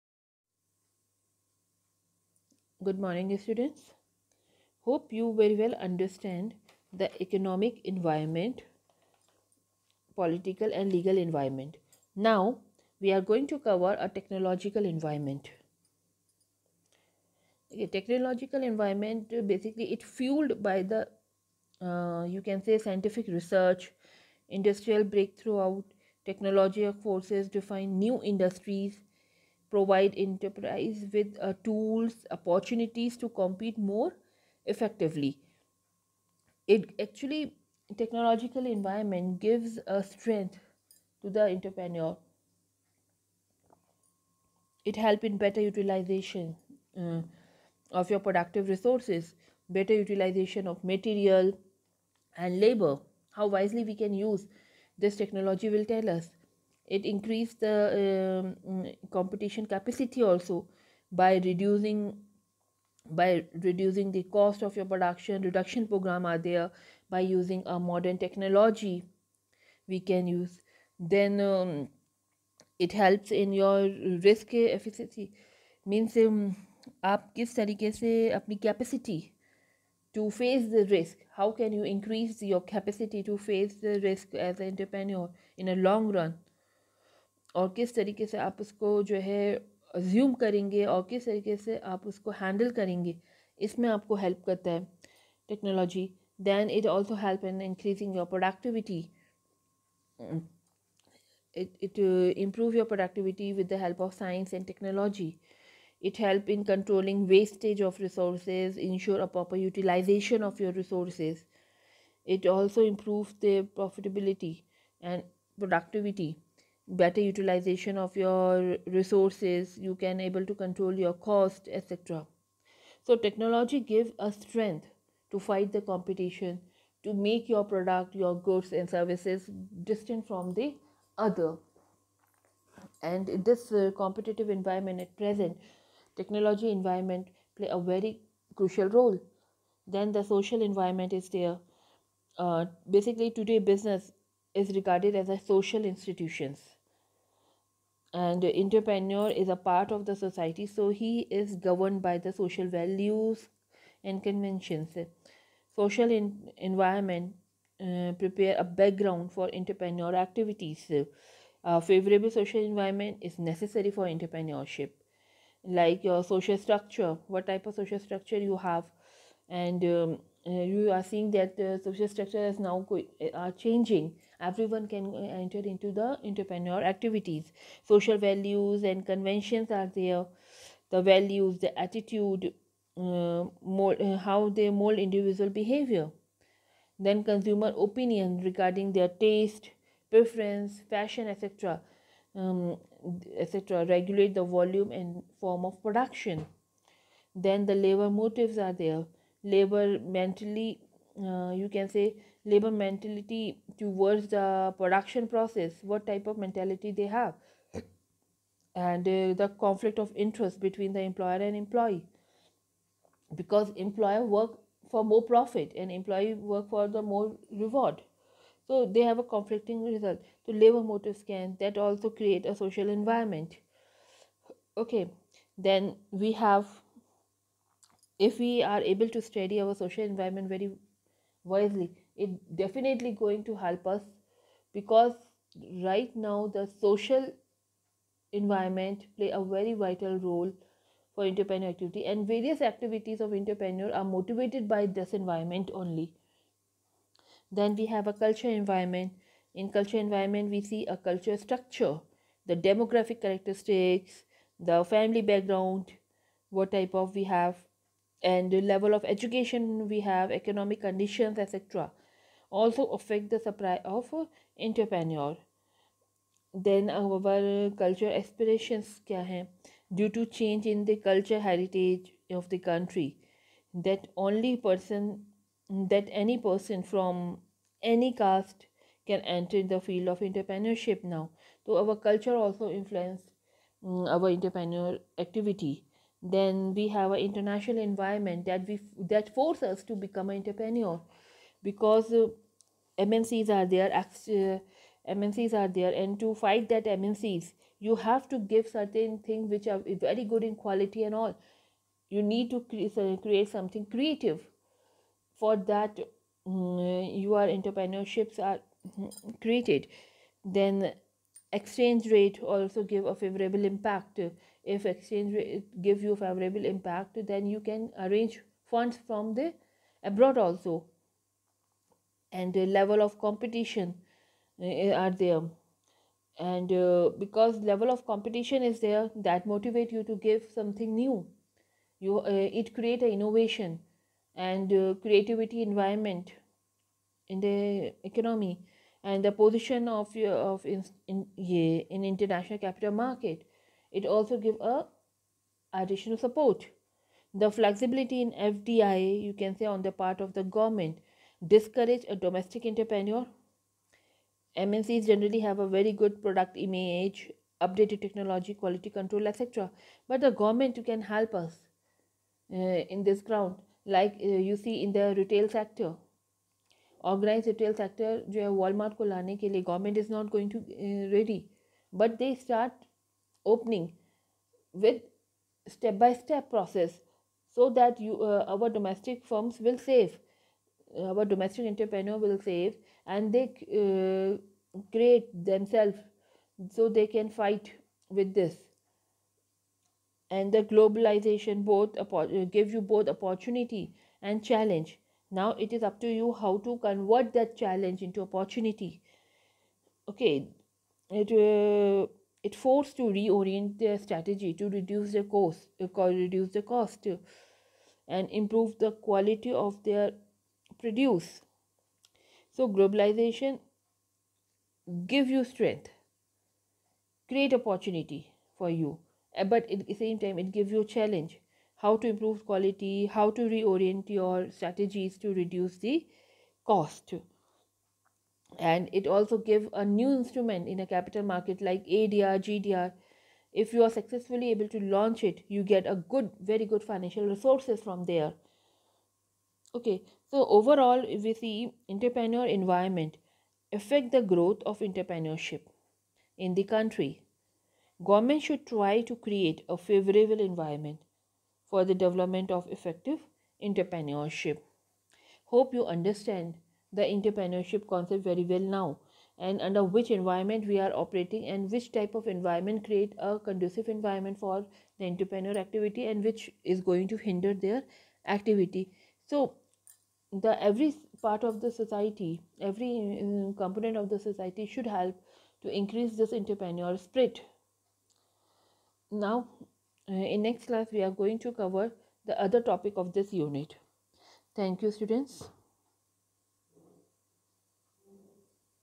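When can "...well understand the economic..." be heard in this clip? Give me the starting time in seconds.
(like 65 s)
5 s.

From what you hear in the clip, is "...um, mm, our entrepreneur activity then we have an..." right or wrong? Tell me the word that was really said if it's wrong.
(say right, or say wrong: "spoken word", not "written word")
right.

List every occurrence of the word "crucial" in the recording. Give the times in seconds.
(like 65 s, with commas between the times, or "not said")
138 s.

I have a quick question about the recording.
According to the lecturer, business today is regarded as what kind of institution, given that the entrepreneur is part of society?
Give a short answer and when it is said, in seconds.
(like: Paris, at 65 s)
social institutions, at 145 s.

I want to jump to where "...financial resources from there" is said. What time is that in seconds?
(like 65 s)
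436 s.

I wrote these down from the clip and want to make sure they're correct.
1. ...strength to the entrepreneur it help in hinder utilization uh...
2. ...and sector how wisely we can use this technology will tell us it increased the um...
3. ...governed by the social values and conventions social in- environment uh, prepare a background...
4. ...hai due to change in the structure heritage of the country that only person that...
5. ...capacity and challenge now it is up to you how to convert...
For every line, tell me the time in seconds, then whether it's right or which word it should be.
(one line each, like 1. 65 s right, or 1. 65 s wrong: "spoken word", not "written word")
1. 40 s wrong: "better", not "hinder"
2. 52 s wrong: "labor", not "sector"
3. 151 s right
4. 269 s wrong: "culture", not "structure"
5. 393 s wrong: "opportunity", not "capacity".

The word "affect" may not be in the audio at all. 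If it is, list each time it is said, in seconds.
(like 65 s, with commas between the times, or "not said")
262 s, 443 s.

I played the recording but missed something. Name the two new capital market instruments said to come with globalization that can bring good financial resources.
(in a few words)
ADR, GDR.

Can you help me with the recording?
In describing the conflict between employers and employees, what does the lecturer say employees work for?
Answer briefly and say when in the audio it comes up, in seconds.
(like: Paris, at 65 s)
more reward, at 217 s.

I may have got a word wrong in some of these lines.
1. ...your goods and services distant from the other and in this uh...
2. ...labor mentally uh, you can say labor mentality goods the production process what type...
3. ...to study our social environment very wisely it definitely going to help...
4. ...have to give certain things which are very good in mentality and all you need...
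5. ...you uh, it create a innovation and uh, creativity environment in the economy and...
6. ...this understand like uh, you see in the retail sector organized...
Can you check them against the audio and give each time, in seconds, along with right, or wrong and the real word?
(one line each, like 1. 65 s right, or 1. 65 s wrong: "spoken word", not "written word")
1. 128 s right
2. 199 s wrong: "towards", not "goods"
3. 229 s right
4. 297 s wrong: "quality", not "mentality"
5. 331 s right
6. 363 s wrong: "ground", not "understand".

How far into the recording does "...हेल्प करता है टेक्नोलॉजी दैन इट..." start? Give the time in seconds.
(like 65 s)
94 s.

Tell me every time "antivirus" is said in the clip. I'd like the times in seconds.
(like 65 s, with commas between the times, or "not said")
not said.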